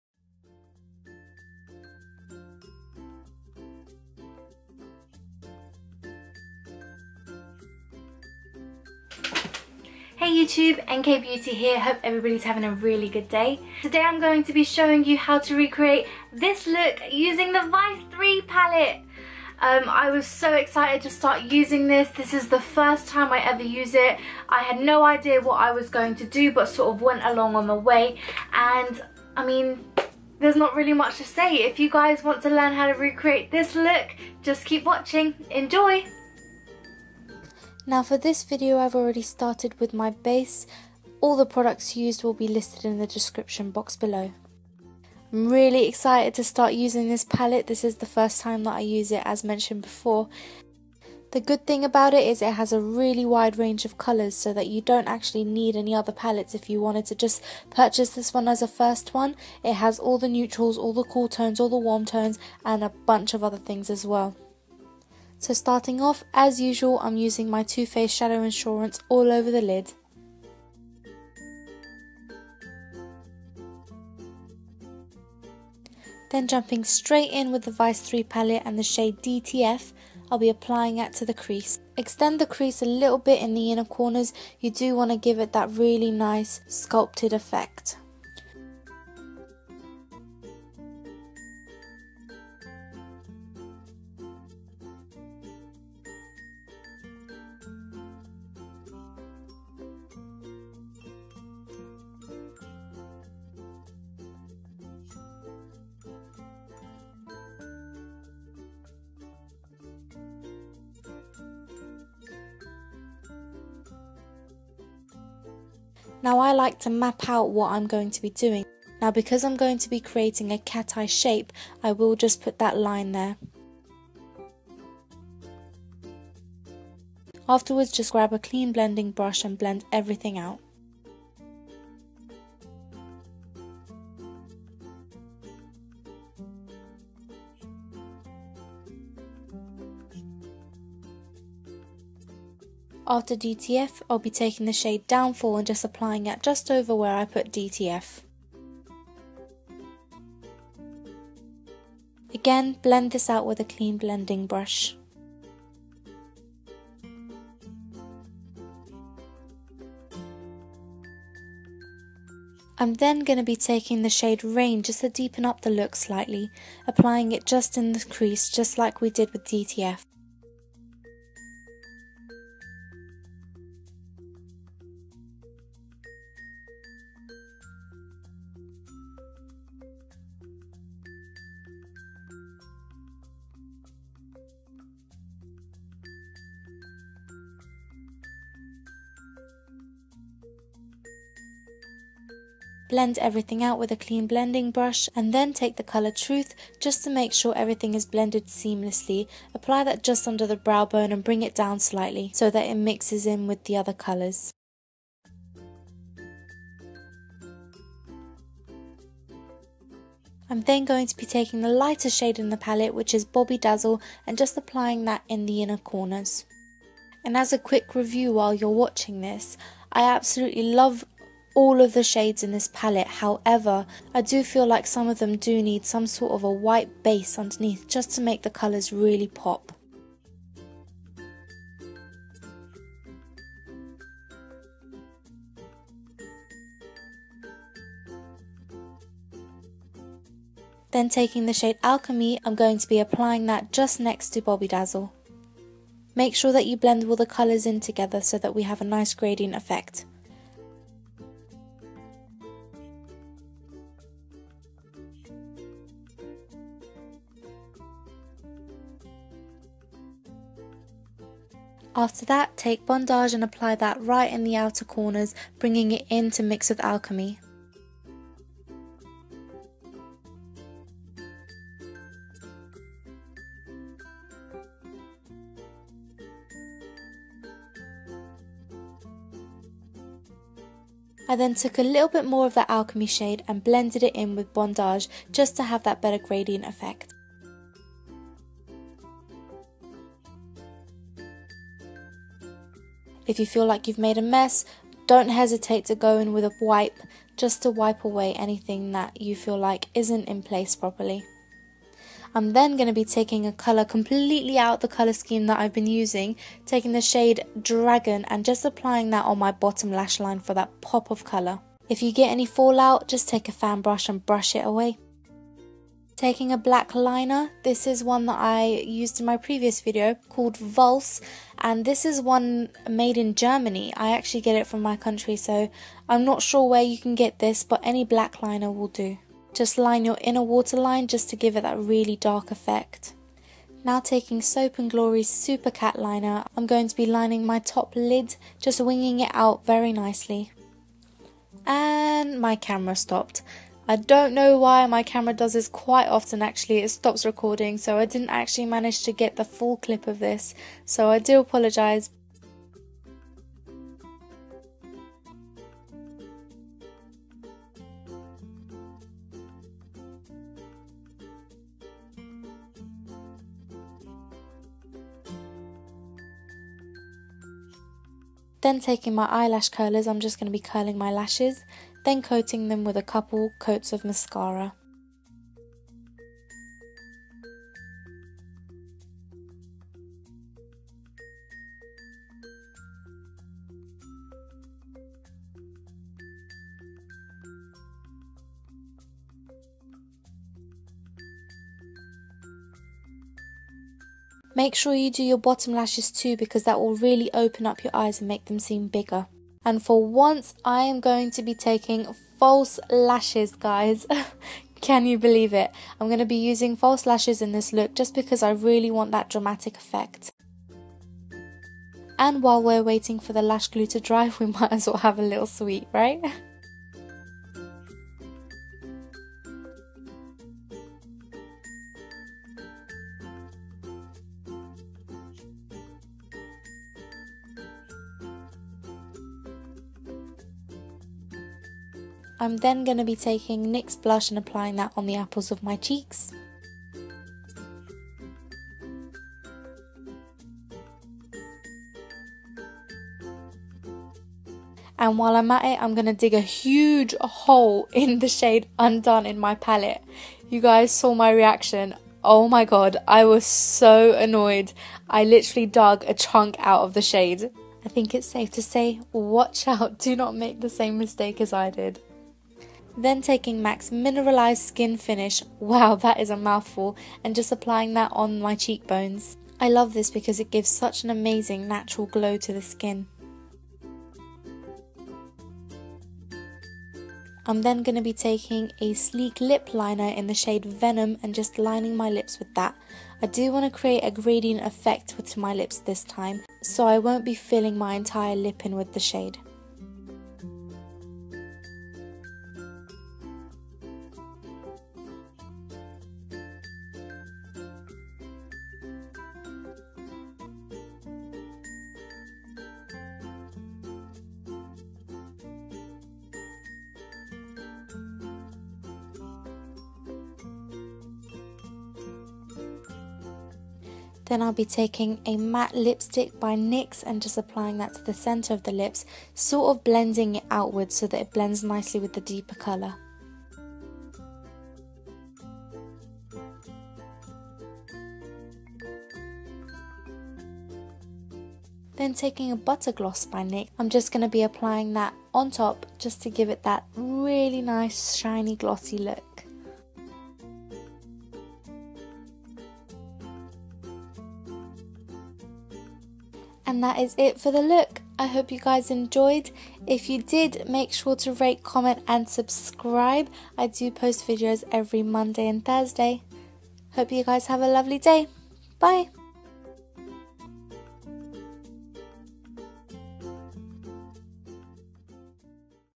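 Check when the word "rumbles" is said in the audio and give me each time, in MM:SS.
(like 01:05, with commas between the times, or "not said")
not said.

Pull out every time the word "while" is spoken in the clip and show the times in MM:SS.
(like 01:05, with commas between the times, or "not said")
03:38, 06:52, 07:25.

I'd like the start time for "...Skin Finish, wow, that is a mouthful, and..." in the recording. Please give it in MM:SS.
07:44.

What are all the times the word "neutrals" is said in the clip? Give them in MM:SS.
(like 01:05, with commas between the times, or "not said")
01:00.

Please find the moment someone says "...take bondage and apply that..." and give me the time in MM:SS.
04:22.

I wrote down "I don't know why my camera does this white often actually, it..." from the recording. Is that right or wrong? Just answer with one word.
wrong.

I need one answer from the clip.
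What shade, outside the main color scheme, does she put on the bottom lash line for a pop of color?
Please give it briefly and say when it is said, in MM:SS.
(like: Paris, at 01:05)
Dragon, at 05:07.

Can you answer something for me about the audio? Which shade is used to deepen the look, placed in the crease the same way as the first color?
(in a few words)
Rain.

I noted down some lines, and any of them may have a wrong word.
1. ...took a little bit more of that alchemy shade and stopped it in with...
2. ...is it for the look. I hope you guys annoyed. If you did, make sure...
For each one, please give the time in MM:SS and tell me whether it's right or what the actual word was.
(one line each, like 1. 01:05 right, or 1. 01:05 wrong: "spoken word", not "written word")
1. 04:41 wrong: "blended", not "stopped"
2. 09:06 wrong: "enjoyed", not "annoyed".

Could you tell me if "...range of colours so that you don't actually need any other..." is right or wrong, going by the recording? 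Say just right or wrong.
right.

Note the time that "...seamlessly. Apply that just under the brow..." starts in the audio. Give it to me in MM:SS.
03:18.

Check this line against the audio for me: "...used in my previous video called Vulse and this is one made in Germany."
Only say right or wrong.
right.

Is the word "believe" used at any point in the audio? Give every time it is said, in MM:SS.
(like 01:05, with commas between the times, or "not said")
06:45.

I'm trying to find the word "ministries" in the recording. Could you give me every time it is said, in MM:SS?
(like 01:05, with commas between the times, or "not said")
not said.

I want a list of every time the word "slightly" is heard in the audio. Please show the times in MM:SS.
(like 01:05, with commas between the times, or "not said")
02:45, 03:21.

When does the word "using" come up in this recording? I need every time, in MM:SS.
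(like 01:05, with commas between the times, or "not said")
00:17, 00:21, 00:46, 01:07, 05:05, 06:46.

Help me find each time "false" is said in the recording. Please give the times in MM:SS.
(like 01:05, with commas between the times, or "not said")
06:42, 06:46.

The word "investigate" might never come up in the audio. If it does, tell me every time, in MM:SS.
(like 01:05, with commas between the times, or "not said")
not said.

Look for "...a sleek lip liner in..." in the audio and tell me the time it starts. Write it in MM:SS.
07:58.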